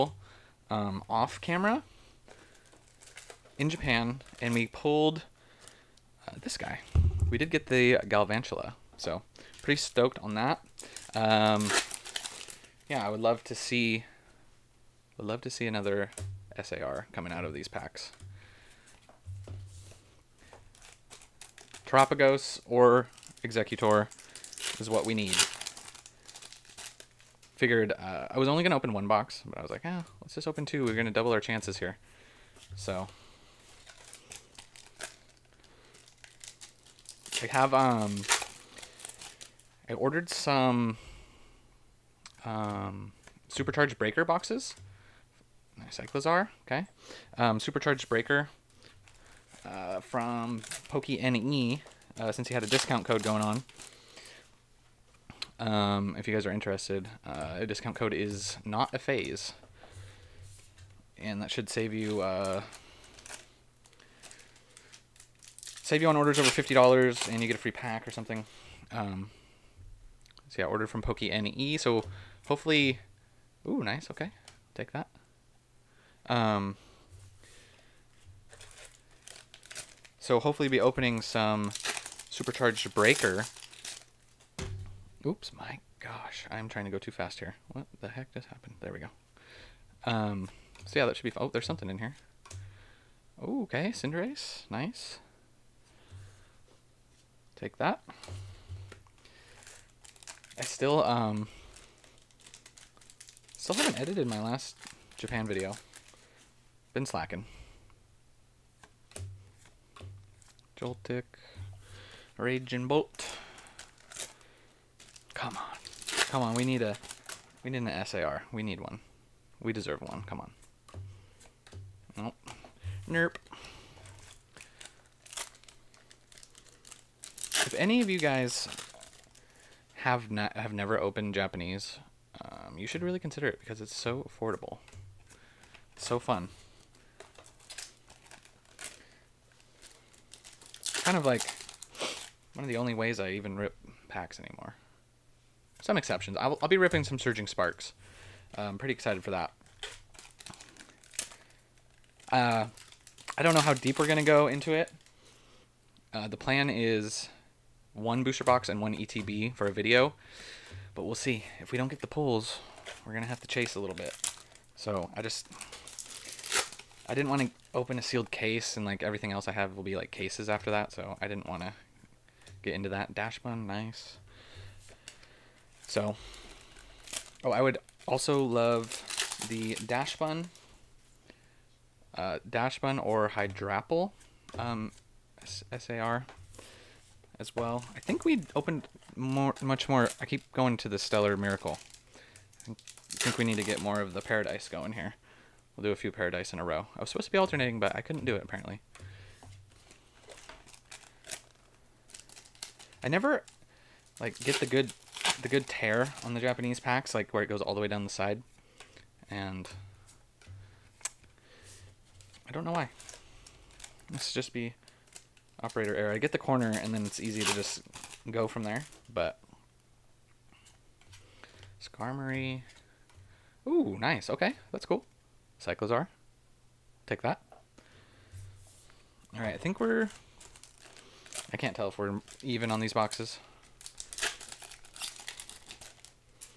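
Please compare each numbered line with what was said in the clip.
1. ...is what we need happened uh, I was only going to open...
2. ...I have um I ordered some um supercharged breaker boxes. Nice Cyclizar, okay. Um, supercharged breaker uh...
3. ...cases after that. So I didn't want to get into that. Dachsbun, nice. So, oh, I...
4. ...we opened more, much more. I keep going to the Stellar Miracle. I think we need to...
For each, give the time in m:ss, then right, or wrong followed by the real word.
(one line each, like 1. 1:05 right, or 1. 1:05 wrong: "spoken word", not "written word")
1. 0:24 wrong: "figured", not "happened"
2. 0:37 right
3. 2:50 right
4. 3:08 right.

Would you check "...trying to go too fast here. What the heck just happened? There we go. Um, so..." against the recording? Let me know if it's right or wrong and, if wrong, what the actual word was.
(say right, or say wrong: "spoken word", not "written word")
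right.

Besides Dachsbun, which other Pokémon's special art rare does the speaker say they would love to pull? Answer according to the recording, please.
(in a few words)
Hydrapple.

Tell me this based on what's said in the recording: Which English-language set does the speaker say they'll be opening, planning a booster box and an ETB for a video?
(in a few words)
Surging Sparks.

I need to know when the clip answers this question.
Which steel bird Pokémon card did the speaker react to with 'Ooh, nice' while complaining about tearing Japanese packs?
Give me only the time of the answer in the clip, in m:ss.
3:41.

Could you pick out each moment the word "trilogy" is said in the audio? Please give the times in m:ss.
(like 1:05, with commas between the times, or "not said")
not said.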